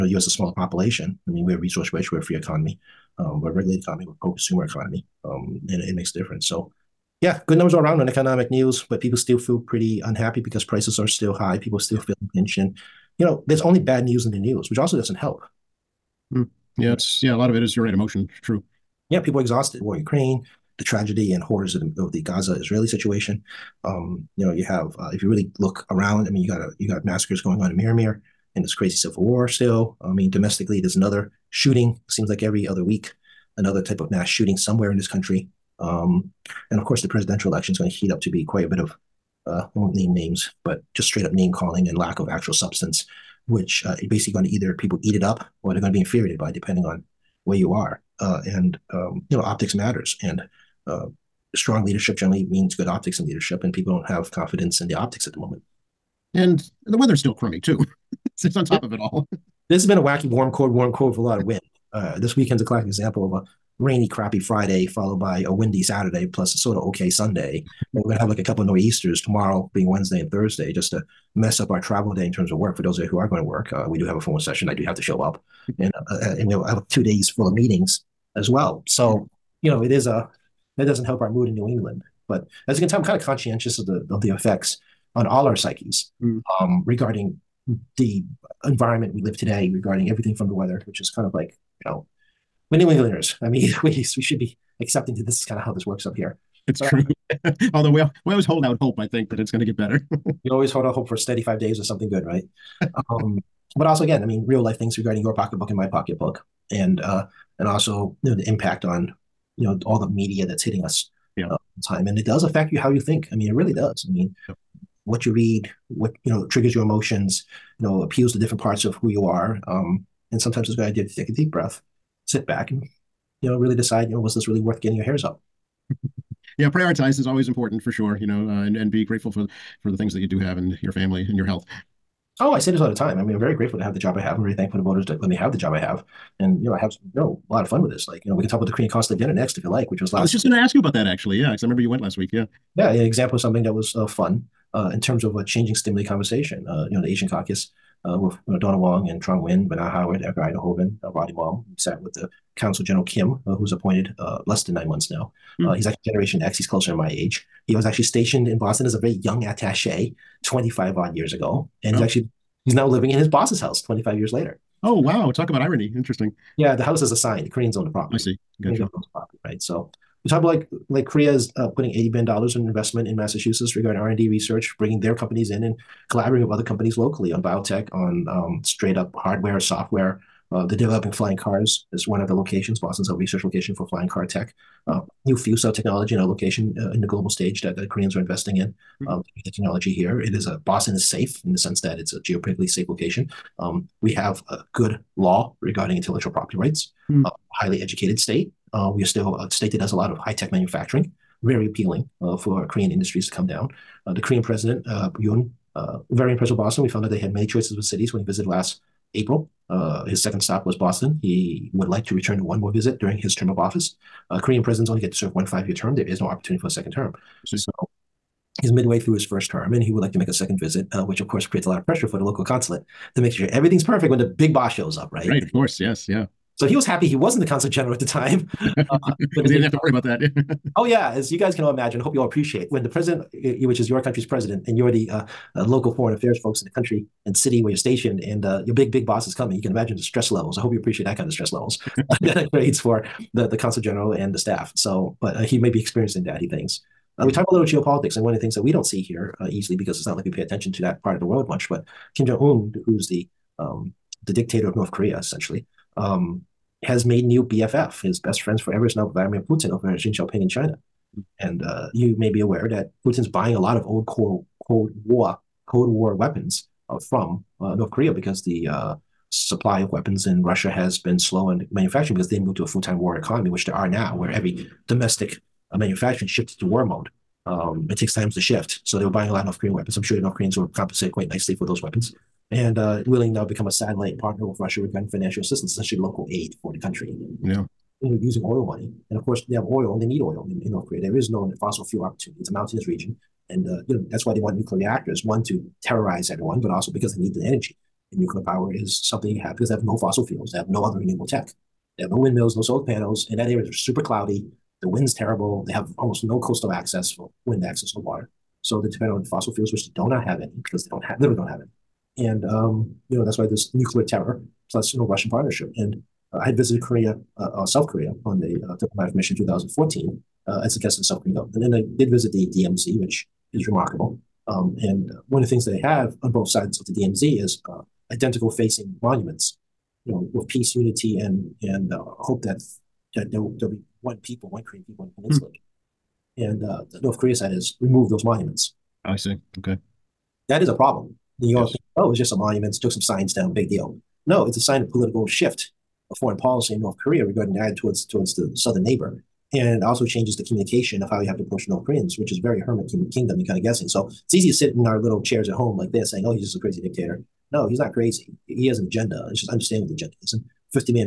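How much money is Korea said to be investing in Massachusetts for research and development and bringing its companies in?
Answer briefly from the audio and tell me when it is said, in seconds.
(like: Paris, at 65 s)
$80 billion, at 171 s.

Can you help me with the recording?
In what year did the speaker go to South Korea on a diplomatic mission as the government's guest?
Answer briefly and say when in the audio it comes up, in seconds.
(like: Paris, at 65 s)
2014, at 319 s.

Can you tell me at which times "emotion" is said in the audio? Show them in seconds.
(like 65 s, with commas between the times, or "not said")
17 s, 116 s.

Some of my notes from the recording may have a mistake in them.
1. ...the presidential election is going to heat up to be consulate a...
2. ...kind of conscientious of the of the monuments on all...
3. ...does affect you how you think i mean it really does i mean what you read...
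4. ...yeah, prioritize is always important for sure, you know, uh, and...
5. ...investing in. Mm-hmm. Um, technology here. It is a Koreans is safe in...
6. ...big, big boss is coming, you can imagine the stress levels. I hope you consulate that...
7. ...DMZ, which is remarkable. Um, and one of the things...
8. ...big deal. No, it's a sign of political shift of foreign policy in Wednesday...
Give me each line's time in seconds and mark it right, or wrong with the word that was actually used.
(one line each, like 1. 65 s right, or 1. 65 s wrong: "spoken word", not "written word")
1. 37 s wrong: "quite", not "consulate"
2. 83 s wrong: "effects", not "monuments"
3. 112 s right
4. 126 s right
5. 188 s wrong: "Boston", not "Koreans"
6. 238 s wrong: "appreciate", not "consulate"
7. 322 s right
8. 343 s wrong: "North", not "Wednesday".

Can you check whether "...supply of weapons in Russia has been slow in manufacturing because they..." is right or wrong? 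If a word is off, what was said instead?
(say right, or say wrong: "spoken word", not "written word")
right.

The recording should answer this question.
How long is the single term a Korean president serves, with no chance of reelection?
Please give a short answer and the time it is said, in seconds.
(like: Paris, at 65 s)
5 years, at 215 s.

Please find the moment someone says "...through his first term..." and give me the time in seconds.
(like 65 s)
218 s.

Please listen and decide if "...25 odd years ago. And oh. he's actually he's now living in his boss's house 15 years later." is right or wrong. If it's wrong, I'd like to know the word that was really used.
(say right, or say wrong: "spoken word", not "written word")
wrong: "25", not "15".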